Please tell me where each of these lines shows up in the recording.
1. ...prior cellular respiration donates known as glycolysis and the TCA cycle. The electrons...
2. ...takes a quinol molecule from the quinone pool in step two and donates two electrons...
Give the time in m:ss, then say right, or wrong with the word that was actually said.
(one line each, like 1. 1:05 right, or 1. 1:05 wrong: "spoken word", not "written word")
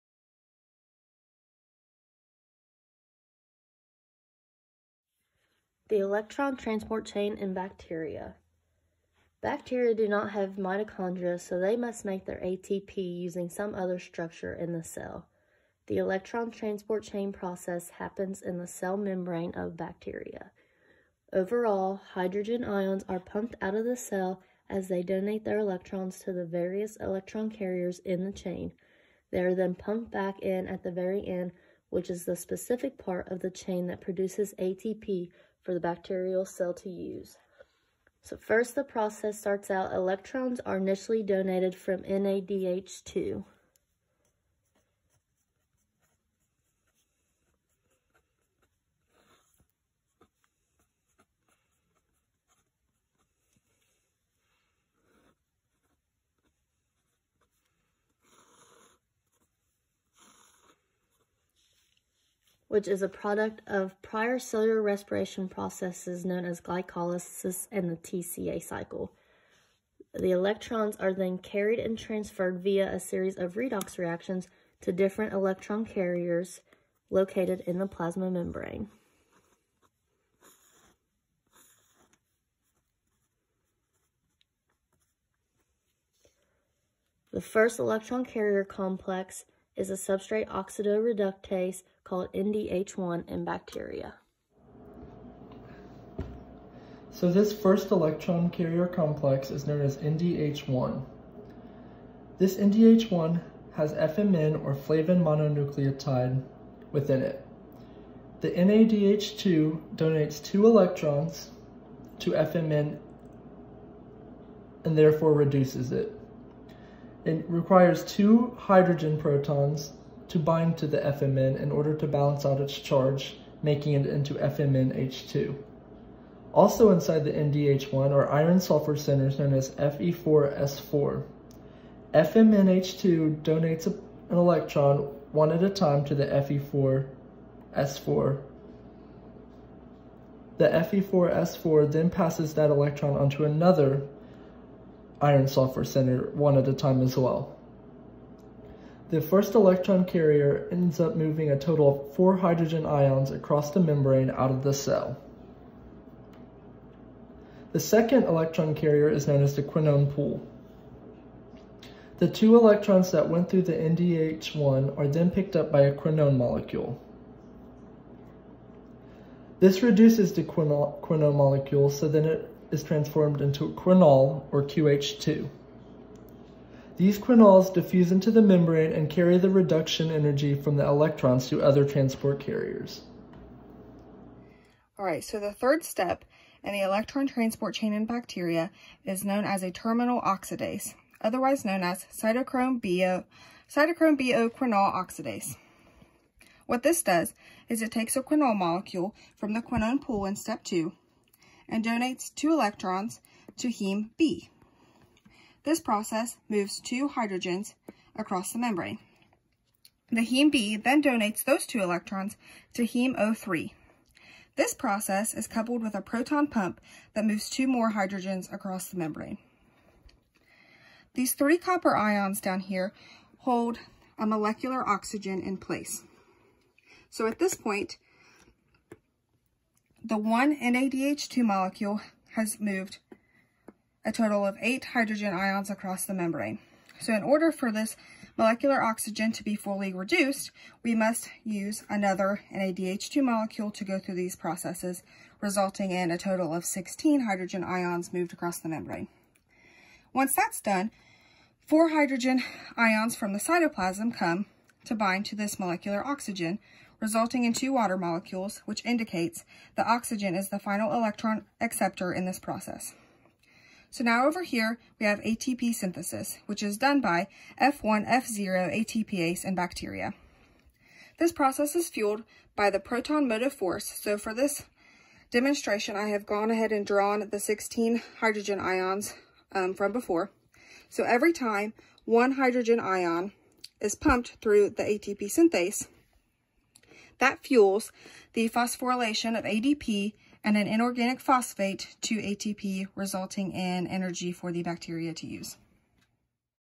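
1. 1:04 wrong: "processes", not "donates"
2. 3:17 right.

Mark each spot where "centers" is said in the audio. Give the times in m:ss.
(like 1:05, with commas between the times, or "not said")
2:08, 2:25.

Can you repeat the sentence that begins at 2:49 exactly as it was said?
This reduces the quinone molecule so that it is transformed into quinol, or QH2.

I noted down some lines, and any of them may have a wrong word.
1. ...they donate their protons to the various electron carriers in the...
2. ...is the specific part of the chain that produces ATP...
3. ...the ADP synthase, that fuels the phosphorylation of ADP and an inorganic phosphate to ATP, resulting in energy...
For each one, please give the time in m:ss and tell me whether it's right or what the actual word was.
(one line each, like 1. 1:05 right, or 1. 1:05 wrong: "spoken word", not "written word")
1. 0:24 wrong: "electrons", not "protons"
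2. 0:32 right
3. 4:44 wrong: "ATP", not "ADP".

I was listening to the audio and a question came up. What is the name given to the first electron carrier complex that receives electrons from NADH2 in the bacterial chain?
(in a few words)
NDH1.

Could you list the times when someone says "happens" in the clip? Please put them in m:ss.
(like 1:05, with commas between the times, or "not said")
0:17.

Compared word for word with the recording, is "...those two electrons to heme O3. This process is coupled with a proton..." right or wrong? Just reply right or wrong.
right.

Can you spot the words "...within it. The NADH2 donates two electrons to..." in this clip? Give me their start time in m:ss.
1:46.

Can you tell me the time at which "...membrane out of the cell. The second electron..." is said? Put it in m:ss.
2:33.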